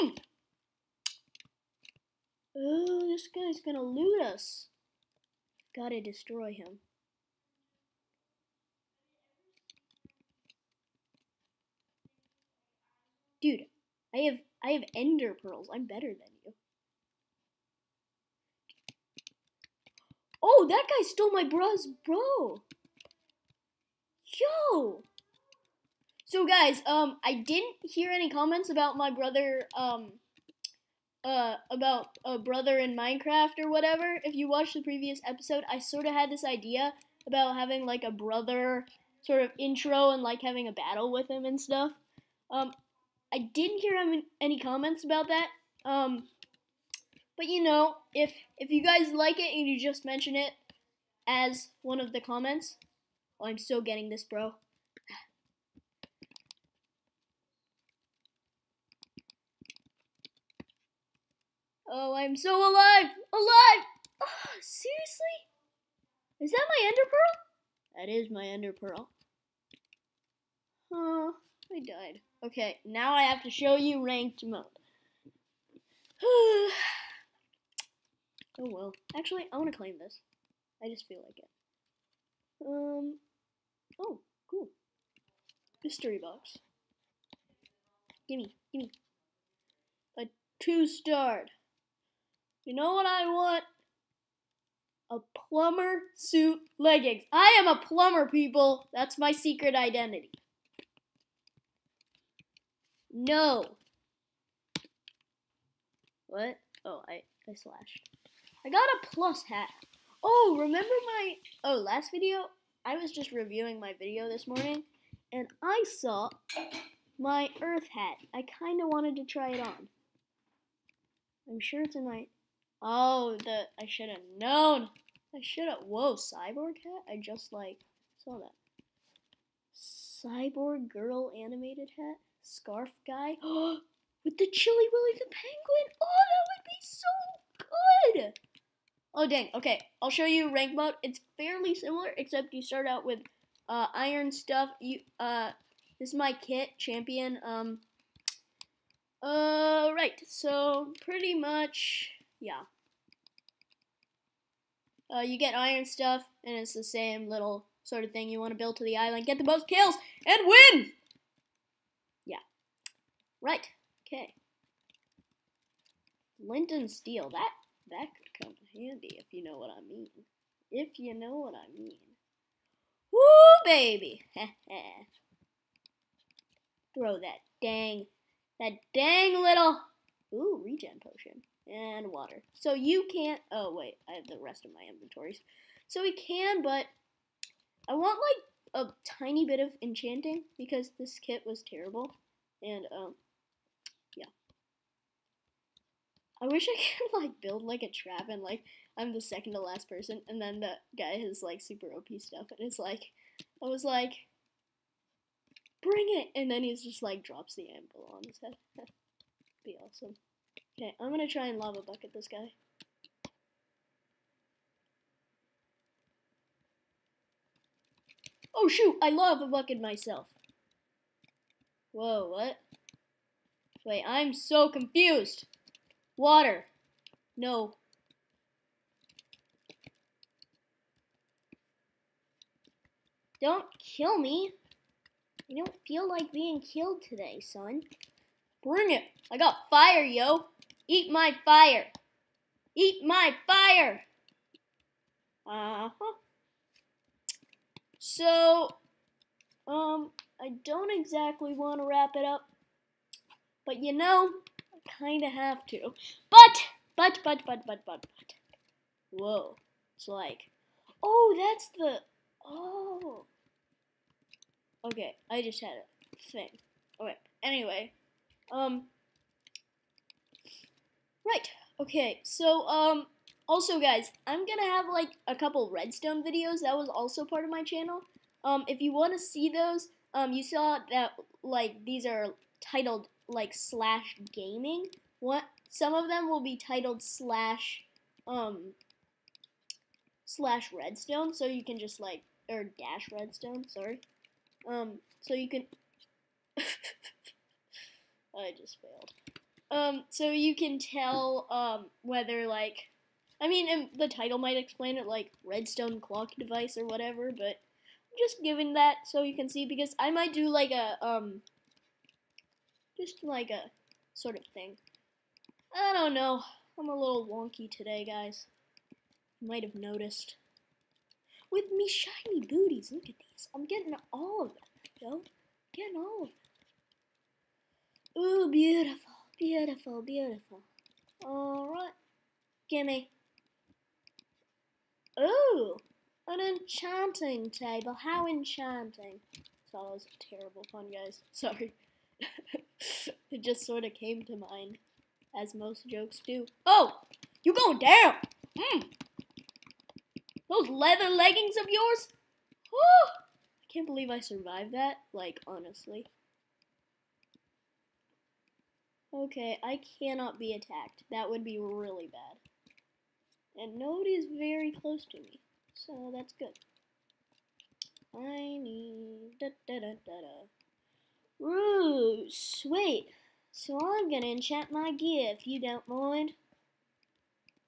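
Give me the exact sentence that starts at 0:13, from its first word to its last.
Dude, I have I have ender pearls.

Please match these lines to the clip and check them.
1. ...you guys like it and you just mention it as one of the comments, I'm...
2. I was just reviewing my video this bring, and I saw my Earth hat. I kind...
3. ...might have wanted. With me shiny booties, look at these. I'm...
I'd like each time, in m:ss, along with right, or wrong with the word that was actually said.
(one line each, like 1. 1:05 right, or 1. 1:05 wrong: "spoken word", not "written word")
1. 0:48 right
2. 1:52 wrong: "morning", not "bring"
3. 5:19 wrong: "noticed", not "wanted".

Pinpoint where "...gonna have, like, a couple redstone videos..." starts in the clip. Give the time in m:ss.
4:34.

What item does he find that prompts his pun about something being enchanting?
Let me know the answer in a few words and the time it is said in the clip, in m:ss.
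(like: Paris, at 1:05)
Enchanting table, at 5:36.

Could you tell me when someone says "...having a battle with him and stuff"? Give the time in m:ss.
0:40.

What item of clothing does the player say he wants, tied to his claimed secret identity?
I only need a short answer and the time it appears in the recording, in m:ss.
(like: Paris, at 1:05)
Plumber suit leggings, at 1:35.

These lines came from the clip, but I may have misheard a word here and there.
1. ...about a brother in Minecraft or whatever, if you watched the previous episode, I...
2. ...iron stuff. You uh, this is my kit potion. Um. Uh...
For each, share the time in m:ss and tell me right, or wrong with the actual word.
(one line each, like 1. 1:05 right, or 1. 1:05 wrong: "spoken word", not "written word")
1. 0:31 right
2. 2:23 wrong: "champion", not "potion".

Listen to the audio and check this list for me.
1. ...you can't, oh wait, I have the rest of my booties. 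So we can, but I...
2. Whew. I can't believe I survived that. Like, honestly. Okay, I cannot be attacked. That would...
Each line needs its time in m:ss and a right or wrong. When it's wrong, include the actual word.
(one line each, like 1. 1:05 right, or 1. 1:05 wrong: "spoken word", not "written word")
1. 3:02 wrong: "inventories", not "booties"
2. 5:52 right.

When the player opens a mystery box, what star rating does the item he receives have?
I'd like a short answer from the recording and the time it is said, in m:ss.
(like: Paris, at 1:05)
Two-starred, at 1:30.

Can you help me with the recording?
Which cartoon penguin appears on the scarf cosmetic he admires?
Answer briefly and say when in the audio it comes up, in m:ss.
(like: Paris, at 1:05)
Chilly Willy, at 2:14.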